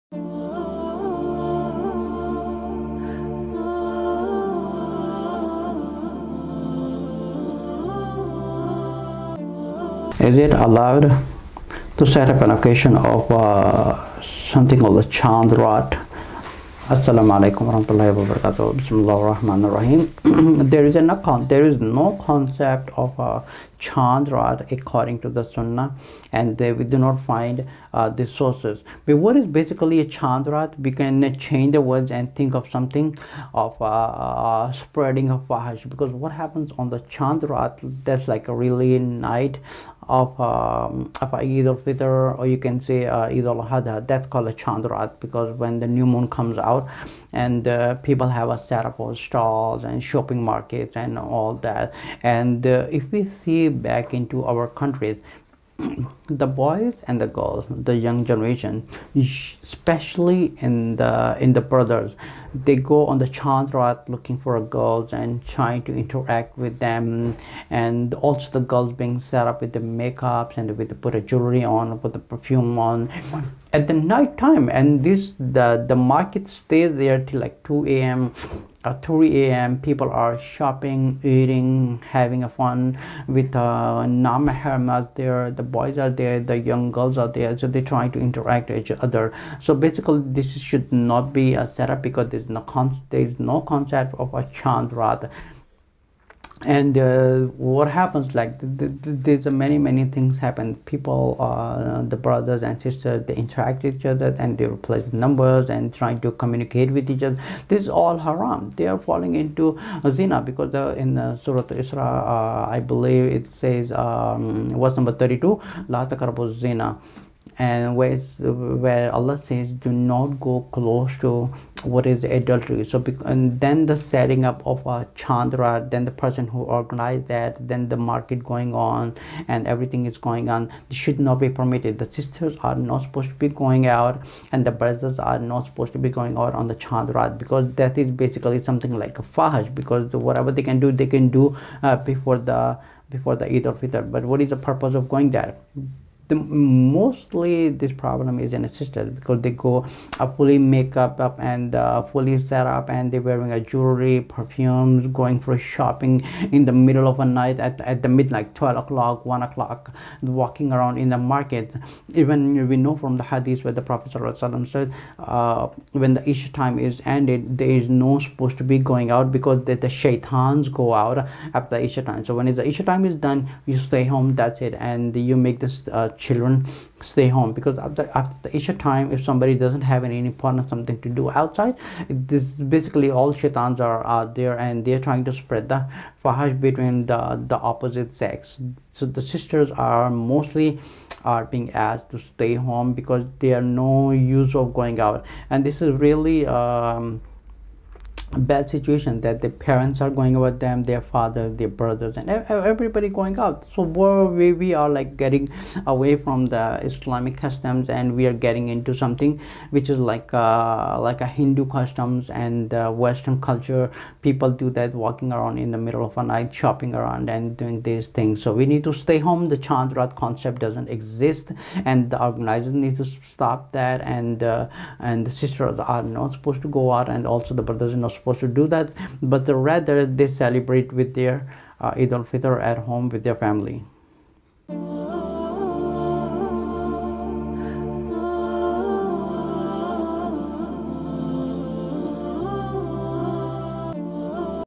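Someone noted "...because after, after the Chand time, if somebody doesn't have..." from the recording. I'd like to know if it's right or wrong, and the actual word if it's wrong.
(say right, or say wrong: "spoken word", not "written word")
wrong: "Isha", not "Chand".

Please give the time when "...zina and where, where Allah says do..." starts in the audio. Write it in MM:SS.
01:56.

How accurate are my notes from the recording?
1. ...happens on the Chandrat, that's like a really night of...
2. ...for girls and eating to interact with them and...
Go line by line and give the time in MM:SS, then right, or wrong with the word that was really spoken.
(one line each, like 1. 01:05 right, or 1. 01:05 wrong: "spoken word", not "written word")
1. 00:36 right
2. 01:04 wrong: "trying", not "eating".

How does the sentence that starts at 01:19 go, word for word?
people are shopping, eating, having a fun with uh, na-mahrams there.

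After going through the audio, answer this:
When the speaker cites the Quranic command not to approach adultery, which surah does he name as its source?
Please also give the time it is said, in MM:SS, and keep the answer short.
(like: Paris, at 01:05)
Surah Isra, at 01:51.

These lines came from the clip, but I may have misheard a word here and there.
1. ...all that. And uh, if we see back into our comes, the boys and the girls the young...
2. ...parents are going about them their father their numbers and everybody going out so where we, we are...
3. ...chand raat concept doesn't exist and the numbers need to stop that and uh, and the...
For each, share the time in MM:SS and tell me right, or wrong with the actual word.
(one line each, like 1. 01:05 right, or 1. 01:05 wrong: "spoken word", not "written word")
1. 00:51 wrong: "countries", not "comes"
2. 03:19 wrong: "brothers", not "numbers"
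3. 03:39 wrong: "organizers", not "numbers".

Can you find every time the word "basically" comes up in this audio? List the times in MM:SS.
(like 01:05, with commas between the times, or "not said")
00:29, 01:29, 02:18, 03:02.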